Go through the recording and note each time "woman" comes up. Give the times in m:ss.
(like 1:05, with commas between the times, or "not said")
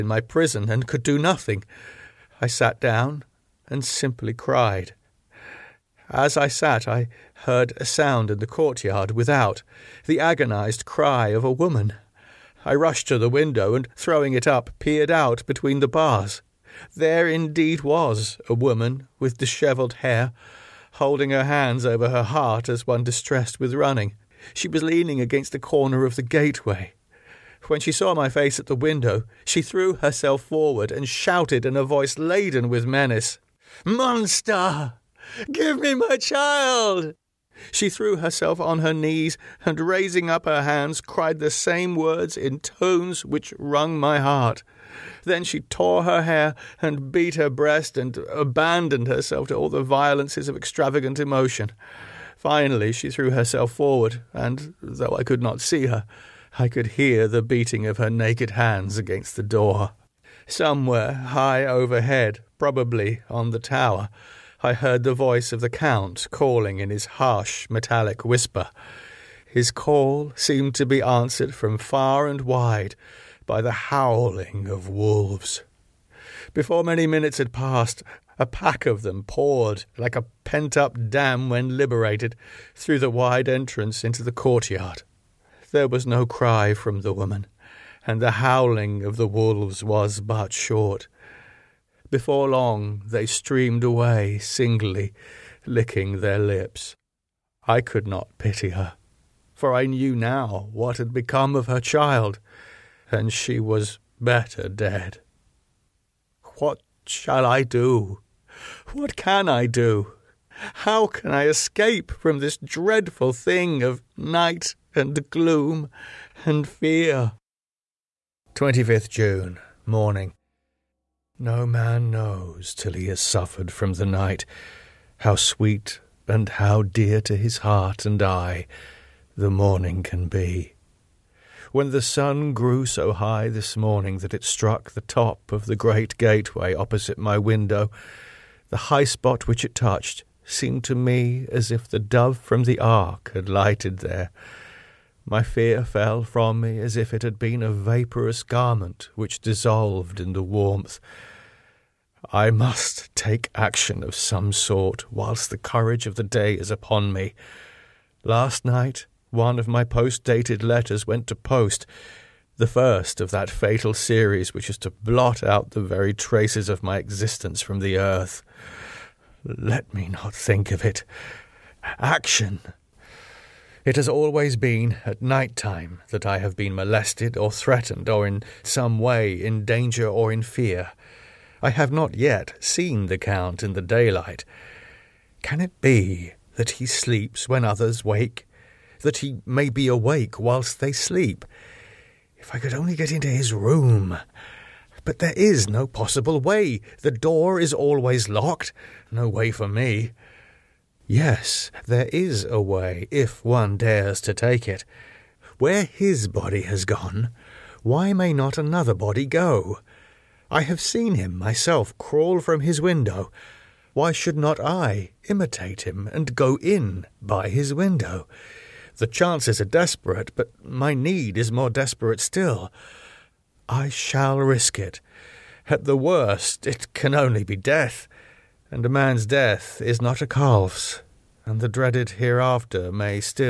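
0:11, 0:18, 1:27.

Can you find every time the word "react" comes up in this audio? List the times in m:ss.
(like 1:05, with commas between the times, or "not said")
not said.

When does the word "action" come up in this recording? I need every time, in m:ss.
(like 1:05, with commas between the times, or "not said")
2:33, 2:51.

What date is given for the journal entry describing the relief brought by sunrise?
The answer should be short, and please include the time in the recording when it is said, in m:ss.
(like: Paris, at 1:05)
25th June, at 1:58.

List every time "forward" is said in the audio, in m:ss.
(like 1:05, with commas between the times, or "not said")
0:30, 0:53.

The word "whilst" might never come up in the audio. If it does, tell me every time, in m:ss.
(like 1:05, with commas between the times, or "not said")
2:35, 3:10.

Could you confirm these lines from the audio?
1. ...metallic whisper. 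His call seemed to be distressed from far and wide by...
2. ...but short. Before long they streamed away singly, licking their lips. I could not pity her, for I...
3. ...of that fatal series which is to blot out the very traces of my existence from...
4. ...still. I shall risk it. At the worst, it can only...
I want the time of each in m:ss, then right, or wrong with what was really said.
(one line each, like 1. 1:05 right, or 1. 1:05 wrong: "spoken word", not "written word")
1. 1:07 wrong: "answered", not "distressed"
2. 1:30 right
3. 2:43 right
4. 3:42 right.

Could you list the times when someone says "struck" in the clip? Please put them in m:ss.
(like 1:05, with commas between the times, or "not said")
2:14.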